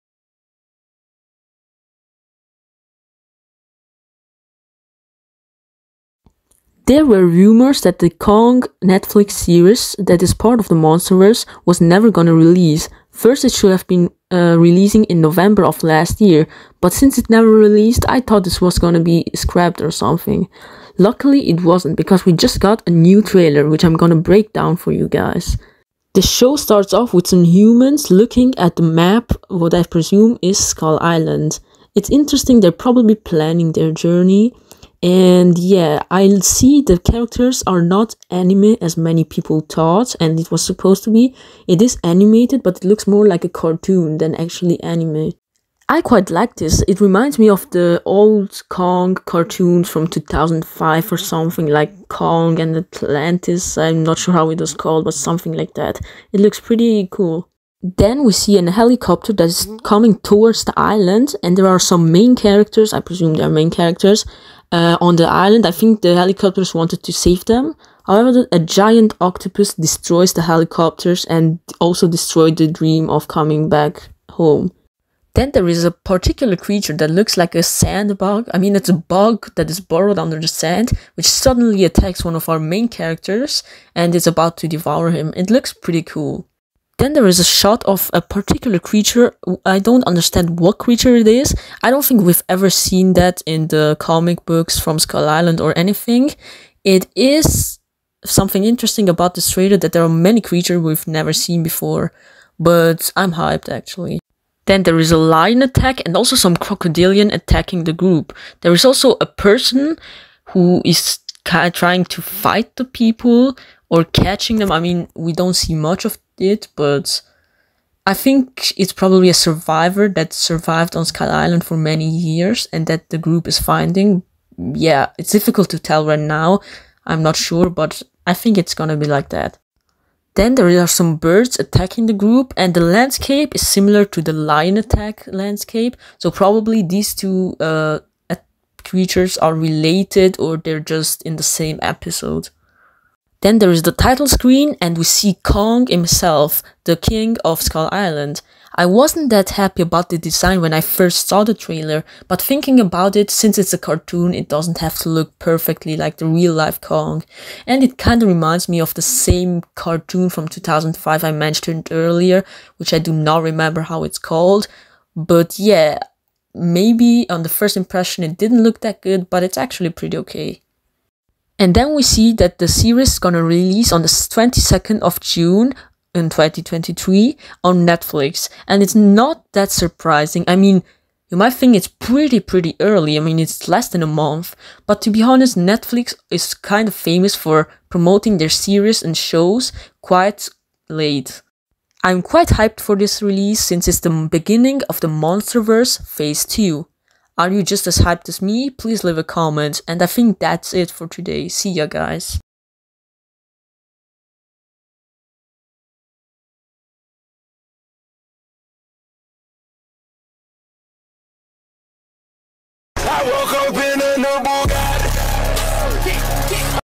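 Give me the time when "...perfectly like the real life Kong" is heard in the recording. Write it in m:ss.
2:35.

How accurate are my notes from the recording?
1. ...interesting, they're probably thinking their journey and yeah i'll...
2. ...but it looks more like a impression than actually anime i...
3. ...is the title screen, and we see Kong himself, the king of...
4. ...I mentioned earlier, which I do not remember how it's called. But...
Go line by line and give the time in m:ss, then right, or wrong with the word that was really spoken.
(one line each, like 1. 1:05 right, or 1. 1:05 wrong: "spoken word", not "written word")
1. 0:32 wrong: "planning", not "thinking"
2. 0:42 wrong: "cartoon", not "impression"
3. 2:23 right
4. 2:41 right.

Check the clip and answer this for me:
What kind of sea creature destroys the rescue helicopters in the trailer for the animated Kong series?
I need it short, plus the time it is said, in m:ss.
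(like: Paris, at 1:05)
Giant octopus, at 1:08.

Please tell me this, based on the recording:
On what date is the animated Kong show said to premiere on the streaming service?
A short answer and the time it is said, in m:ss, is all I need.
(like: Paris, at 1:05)
22 June 2023, at 2:54.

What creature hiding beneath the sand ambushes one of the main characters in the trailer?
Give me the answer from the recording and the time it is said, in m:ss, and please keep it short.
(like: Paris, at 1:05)
Sand bug, at 1:17.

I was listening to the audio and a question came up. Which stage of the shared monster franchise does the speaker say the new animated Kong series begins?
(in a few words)
Monsterverse Phase 2.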